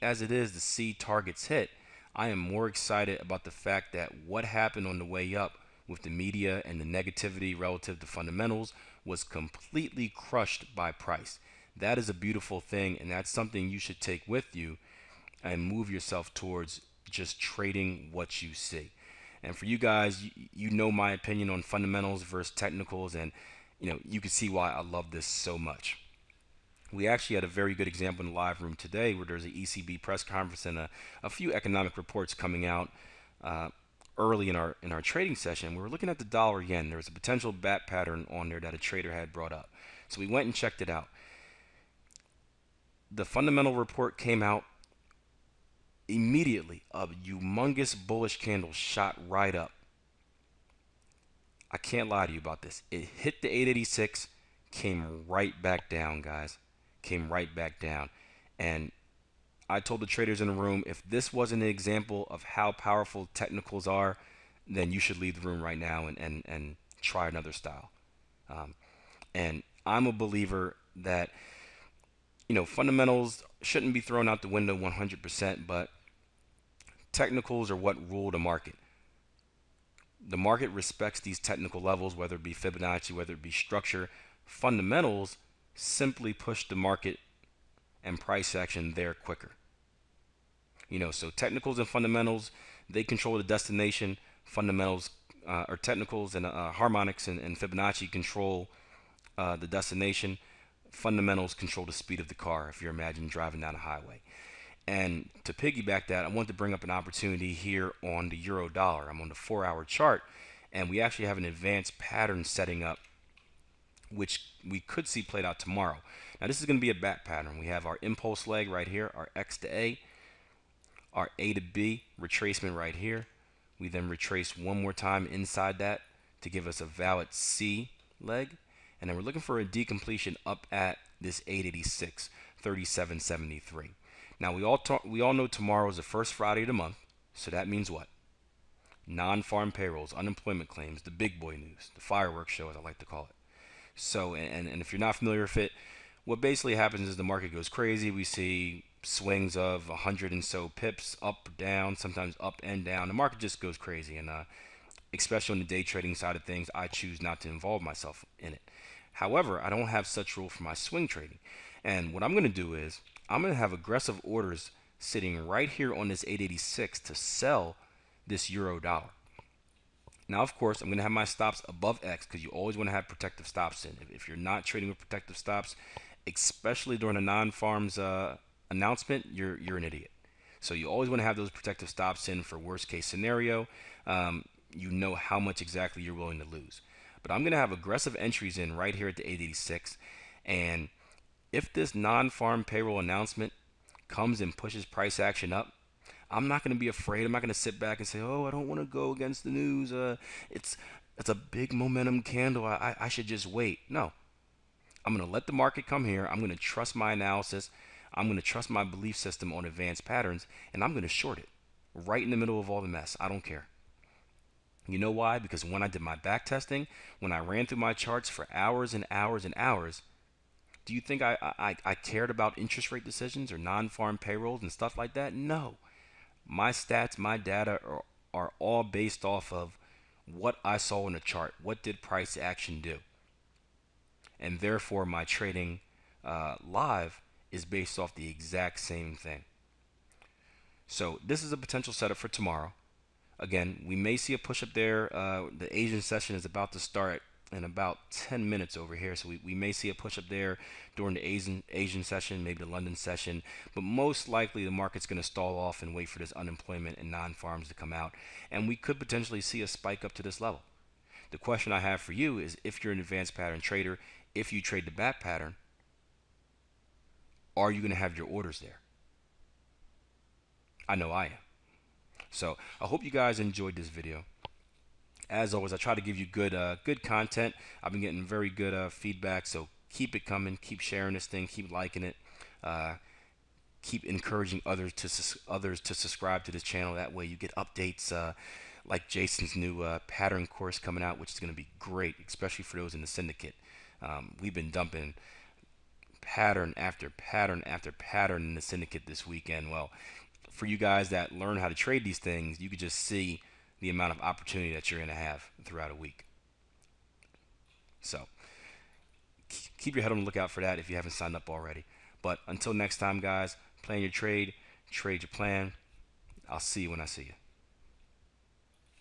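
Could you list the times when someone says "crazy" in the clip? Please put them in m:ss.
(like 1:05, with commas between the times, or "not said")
2:27, 2:33.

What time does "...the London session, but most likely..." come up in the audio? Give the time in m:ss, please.
4:12.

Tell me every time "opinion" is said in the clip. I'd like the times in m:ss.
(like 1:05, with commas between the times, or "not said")
0:21.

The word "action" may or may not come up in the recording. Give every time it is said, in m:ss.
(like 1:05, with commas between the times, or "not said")
1:28, 3:15, 3:52.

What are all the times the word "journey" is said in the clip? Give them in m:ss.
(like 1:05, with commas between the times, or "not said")
not said.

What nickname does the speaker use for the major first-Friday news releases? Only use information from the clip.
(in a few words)
the fireworks show.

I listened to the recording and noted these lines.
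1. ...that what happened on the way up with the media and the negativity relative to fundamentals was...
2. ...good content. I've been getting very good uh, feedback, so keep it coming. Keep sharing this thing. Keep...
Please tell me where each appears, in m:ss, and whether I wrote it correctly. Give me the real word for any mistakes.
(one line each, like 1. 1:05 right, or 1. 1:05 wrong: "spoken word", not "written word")
1. 0:03 right
2. 4:36 right.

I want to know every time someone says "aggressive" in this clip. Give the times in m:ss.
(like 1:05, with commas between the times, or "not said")
2:43, 3:07.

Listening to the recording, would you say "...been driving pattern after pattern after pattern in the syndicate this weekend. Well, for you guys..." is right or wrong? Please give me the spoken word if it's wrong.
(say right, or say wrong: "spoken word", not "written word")
wrong: "dumping", not "driving".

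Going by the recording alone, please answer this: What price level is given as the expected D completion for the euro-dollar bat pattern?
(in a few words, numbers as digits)
3773.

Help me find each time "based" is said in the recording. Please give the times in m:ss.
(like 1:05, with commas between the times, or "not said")
3:48, 3:57.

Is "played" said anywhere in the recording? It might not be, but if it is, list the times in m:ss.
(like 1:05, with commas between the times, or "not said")
1:55.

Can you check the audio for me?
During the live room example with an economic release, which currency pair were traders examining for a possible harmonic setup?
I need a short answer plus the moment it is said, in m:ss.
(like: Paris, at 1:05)
dollar yen, at 0:36.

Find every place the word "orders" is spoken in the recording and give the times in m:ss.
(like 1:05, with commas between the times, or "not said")
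2:44, 4:28.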